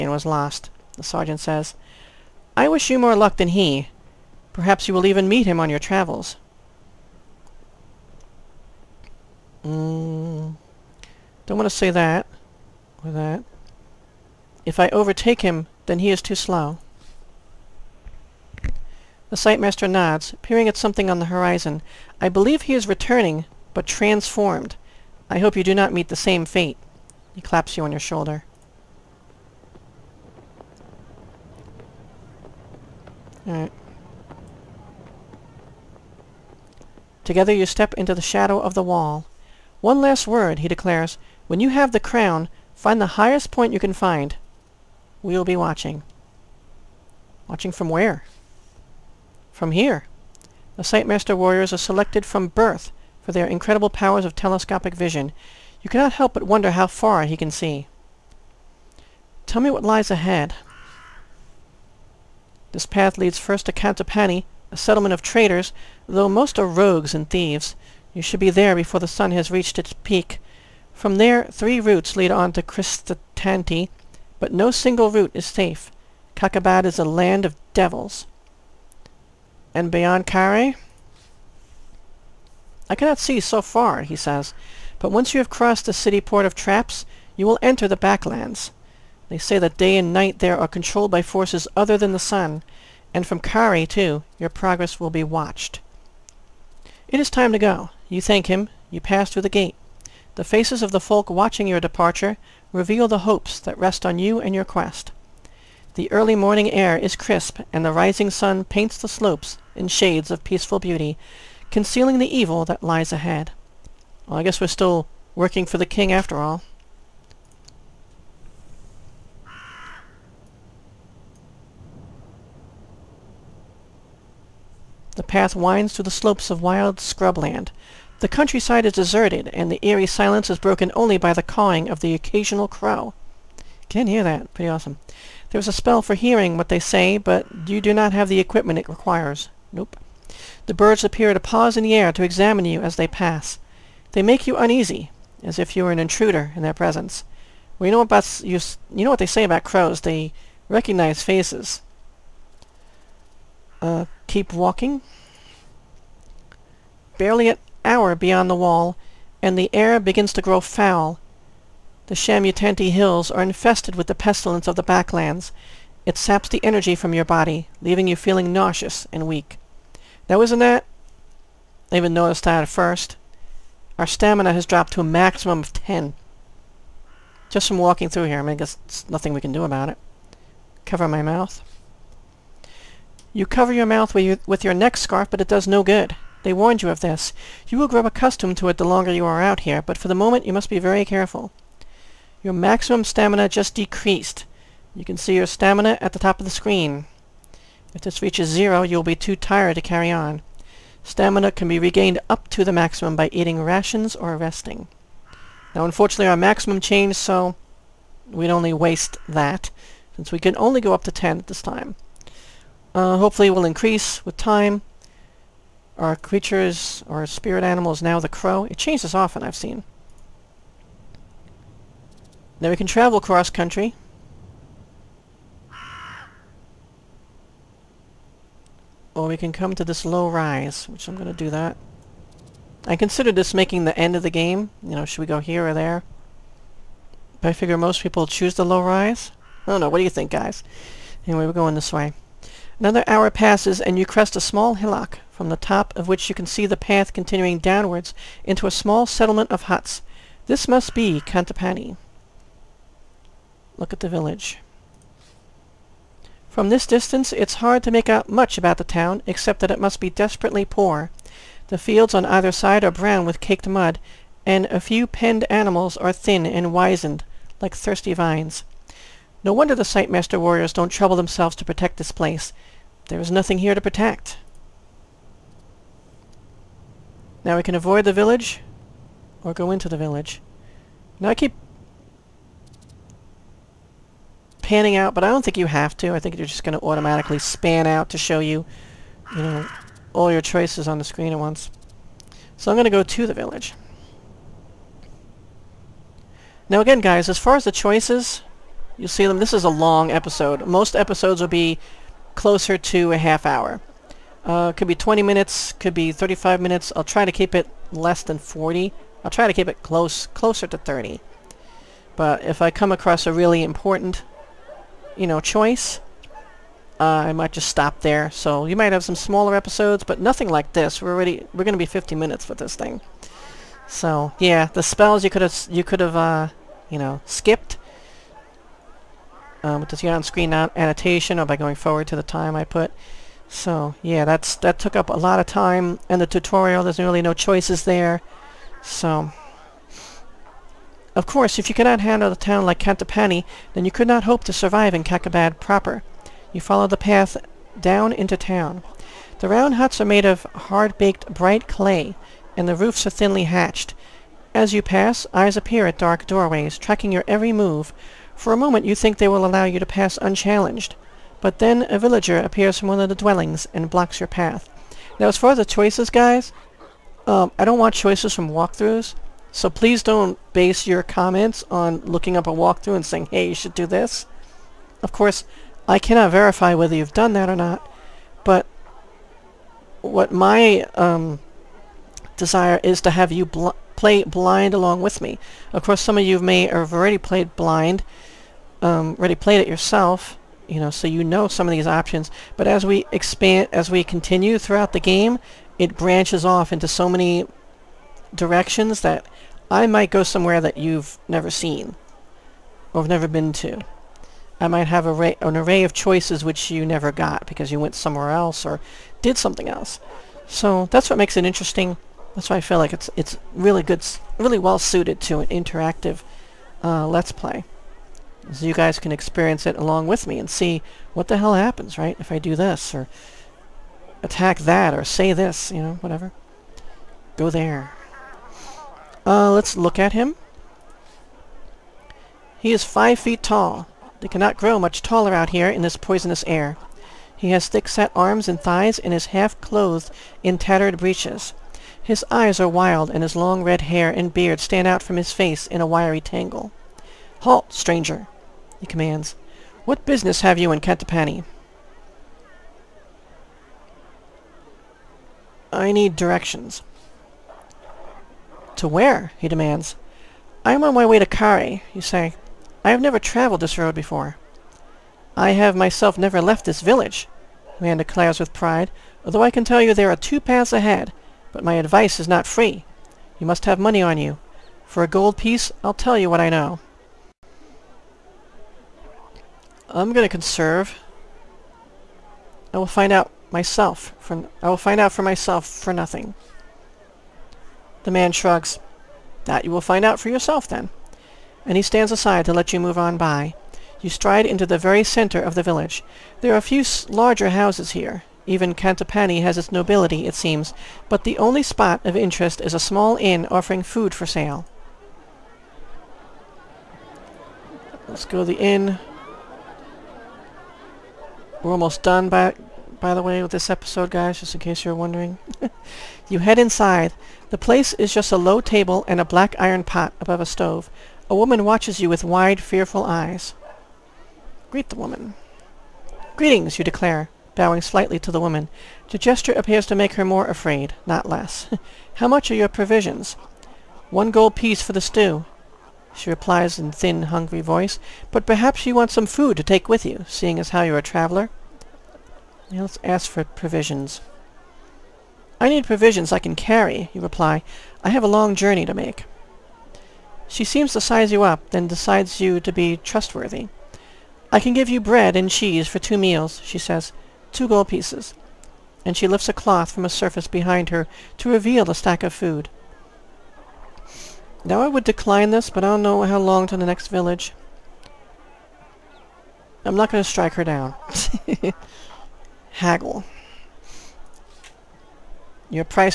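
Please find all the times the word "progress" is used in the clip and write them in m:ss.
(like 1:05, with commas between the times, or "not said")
1:34.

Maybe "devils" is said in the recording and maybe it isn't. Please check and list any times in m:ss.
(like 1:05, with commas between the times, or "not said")
1:17.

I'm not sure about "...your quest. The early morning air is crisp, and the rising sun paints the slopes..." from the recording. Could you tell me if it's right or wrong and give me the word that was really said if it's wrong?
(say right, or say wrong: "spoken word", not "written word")
right.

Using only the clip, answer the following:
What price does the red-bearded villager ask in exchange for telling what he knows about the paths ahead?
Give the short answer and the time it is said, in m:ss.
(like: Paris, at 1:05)
1 gold piece, at 7:55.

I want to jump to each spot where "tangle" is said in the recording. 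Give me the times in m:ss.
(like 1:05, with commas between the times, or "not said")
7:26.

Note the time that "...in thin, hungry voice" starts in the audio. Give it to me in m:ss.
8:56.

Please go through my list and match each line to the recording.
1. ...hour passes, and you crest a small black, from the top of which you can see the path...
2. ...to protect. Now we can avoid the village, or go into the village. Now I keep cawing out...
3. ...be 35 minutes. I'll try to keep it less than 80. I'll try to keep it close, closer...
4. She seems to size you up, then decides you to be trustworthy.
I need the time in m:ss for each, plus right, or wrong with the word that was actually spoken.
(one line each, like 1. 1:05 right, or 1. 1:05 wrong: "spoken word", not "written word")
1. 4:03 wrong: "hillock", not "black"
2. 4:33 wrong: "panning", not "cawing"
3. 5:05 wrong: "40", not "80"
4. 9:10 right.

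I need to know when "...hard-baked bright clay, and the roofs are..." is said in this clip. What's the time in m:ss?
5:50.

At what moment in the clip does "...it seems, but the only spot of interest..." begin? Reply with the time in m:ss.
8:20.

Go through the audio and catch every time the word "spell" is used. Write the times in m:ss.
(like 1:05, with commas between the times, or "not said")
2:15, 5:24.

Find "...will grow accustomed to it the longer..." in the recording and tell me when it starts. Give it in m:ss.
3:07.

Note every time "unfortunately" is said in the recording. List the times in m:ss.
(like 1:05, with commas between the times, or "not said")
3:25.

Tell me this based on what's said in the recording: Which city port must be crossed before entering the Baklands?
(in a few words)
Traps.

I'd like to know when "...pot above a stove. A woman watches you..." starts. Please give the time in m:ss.
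8:39.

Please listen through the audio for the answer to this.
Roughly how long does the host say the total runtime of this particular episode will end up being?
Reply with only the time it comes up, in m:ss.
5:21.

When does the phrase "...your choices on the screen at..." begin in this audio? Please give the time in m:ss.
4:50.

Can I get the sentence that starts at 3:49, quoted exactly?
Or we can come to this low rise, which I'm gonna do that.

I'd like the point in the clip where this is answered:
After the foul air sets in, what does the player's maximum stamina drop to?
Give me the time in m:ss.
2:55.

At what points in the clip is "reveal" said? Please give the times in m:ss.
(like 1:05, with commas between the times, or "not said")
1:42, 9:21.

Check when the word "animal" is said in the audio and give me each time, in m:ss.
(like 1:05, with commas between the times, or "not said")
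3:37, 4:25.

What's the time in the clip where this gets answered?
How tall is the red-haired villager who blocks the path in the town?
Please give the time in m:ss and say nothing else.
7:12.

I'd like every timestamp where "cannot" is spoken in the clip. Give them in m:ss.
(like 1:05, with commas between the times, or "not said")
0:55, 1:22, 5:41, 6:15, 7:14.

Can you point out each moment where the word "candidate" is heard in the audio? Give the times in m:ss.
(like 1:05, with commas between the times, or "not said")
not said.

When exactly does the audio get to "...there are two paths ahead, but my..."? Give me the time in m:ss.
7:49.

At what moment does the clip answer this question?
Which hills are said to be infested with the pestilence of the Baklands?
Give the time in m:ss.
2:42.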